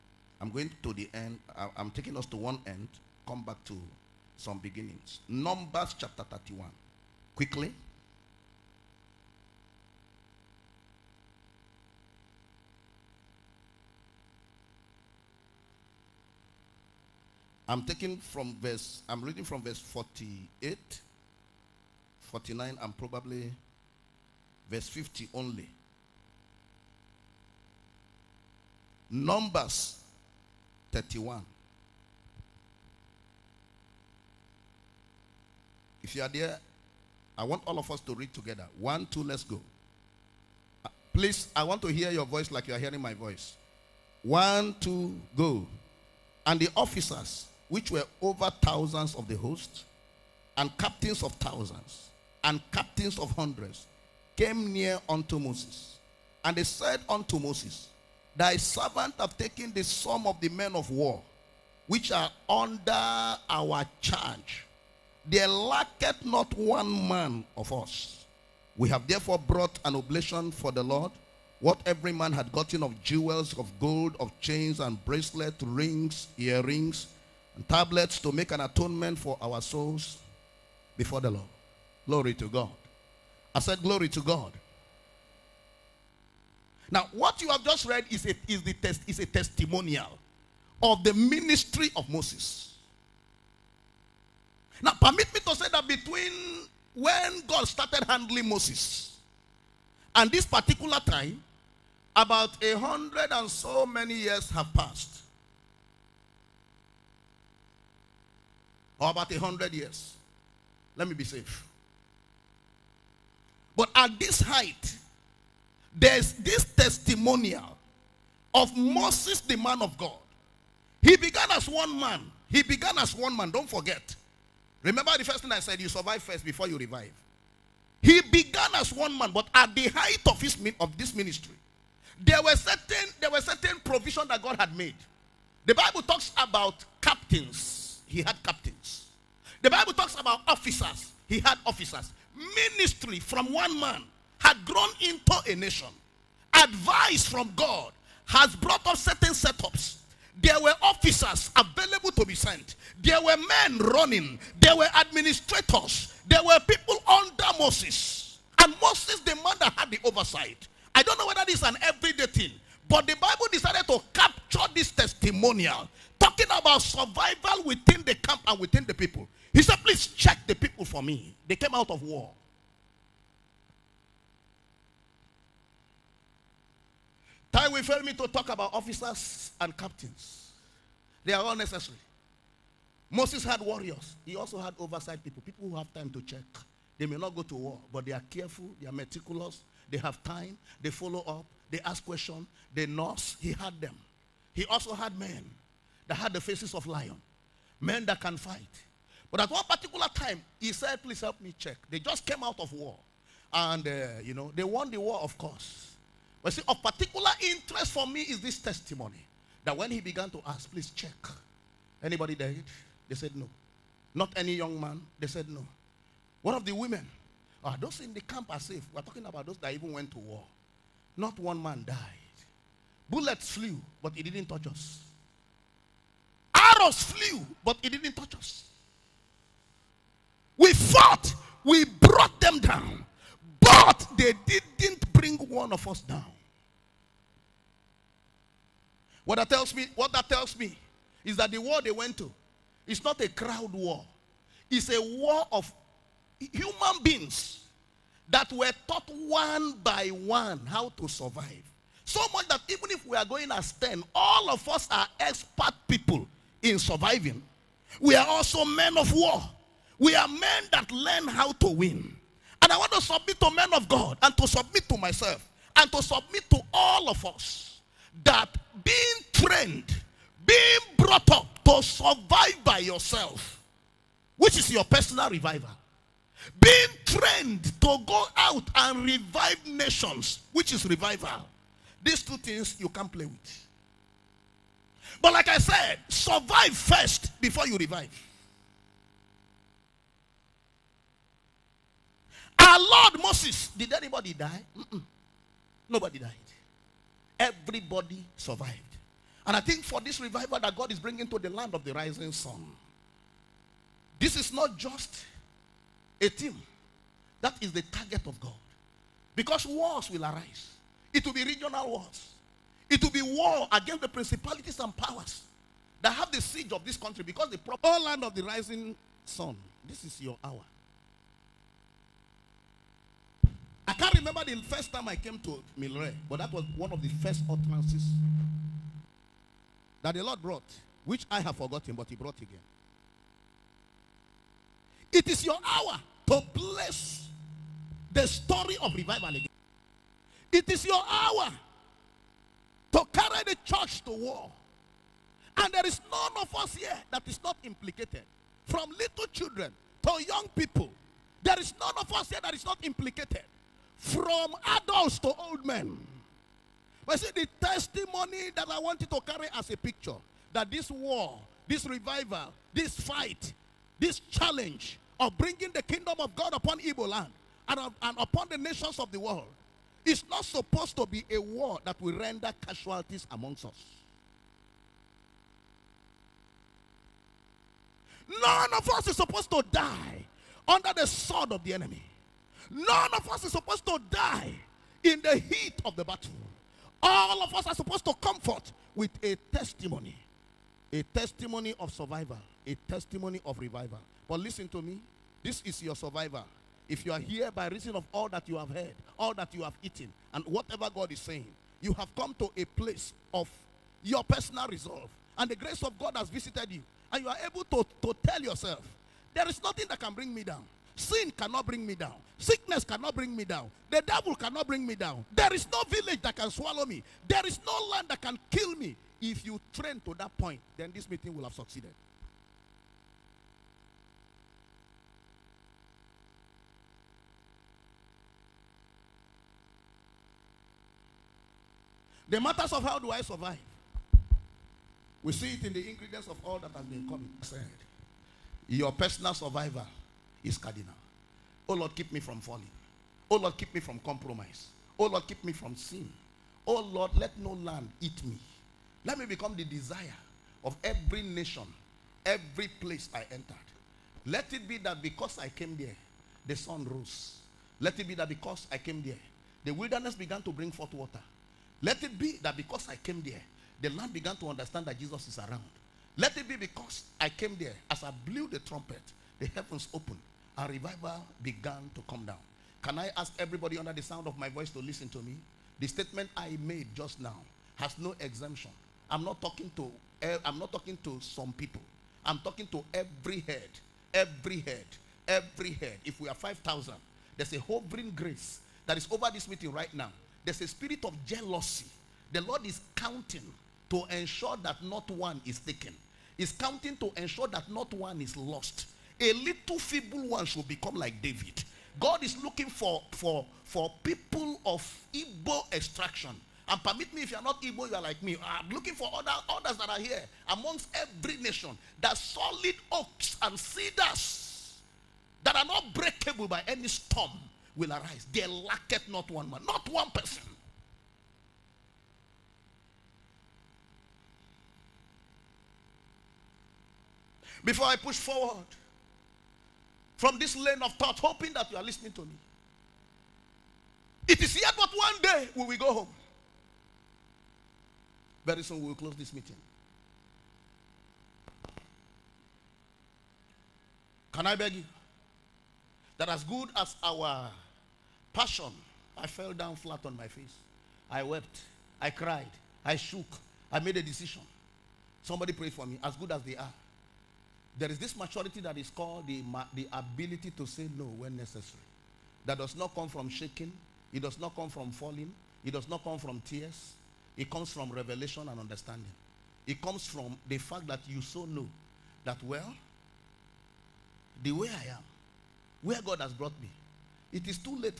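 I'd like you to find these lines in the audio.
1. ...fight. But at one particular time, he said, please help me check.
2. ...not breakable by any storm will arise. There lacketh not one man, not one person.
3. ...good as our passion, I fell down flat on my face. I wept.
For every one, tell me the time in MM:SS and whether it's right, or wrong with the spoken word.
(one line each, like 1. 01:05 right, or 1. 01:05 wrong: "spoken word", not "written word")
1. 03:18 right
2. 08:35 right
3. 09:06 right.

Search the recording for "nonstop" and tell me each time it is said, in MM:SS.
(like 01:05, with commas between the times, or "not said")
not said.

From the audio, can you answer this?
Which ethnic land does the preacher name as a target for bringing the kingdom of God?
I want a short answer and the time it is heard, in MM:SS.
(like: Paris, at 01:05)
Igbo land, at 06:06.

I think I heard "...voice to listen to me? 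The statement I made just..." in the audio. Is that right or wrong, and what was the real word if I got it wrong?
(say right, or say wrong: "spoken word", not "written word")
right.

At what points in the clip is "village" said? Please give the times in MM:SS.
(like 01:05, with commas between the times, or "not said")
06:55.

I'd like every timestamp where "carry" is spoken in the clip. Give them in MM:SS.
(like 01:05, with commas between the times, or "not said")
05:43, 05:59.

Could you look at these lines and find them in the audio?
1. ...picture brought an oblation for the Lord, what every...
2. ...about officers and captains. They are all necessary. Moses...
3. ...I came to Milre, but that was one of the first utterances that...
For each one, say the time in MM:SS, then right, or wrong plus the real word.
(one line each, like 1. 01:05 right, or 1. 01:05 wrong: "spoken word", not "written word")
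1. 01:09 wrong: "therefore", not "picture"
2. 02:58 right
3. 05:25 right.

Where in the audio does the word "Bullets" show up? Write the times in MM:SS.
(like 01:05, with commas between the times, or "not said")
03:43.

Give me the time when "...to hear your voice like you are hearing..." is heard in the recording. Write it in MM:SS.
00:41.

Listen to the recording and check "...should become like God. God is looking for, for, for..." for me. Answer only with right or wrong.
wrong.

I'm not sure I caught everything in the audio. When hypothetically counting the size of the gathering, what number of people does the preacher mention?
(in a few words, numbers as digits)
5,000.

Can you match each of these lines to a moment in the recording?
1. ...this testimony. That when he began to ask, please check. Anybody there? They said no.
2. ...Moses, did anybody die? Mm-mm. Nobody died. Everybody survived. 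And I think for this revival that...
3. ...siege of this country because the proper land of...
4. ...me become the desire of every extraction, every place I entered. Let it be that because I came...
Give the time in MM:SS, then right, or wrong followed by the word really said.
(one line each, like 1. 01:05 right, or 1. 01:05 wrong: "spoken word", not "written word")
1. 03:28 right
2. 04:53 right
3. 05:16 right
4. 07:29 wrong: "nation", not "extraction".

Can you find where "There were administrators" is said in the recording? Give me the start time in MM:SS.
02:34.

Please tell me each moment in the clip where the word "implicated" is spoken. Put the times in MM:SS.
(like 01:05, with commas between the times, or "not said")
05:47, 05:52.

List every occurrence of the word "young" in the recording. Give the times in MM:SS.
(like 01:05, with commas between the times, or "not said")
03:34, 05:50.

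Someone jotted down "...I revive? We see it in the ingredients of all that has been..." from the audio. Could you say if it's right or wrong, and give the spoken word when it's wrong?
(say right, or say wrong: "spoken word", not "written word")
wrong: "survive", not "revive".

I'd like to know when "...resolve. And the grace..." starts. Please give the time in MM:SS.
06:44.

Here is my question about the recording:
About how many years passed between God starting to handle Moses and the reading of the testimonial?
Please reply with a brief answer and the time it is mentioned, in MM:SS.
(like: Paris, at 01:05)
100, at 01:49.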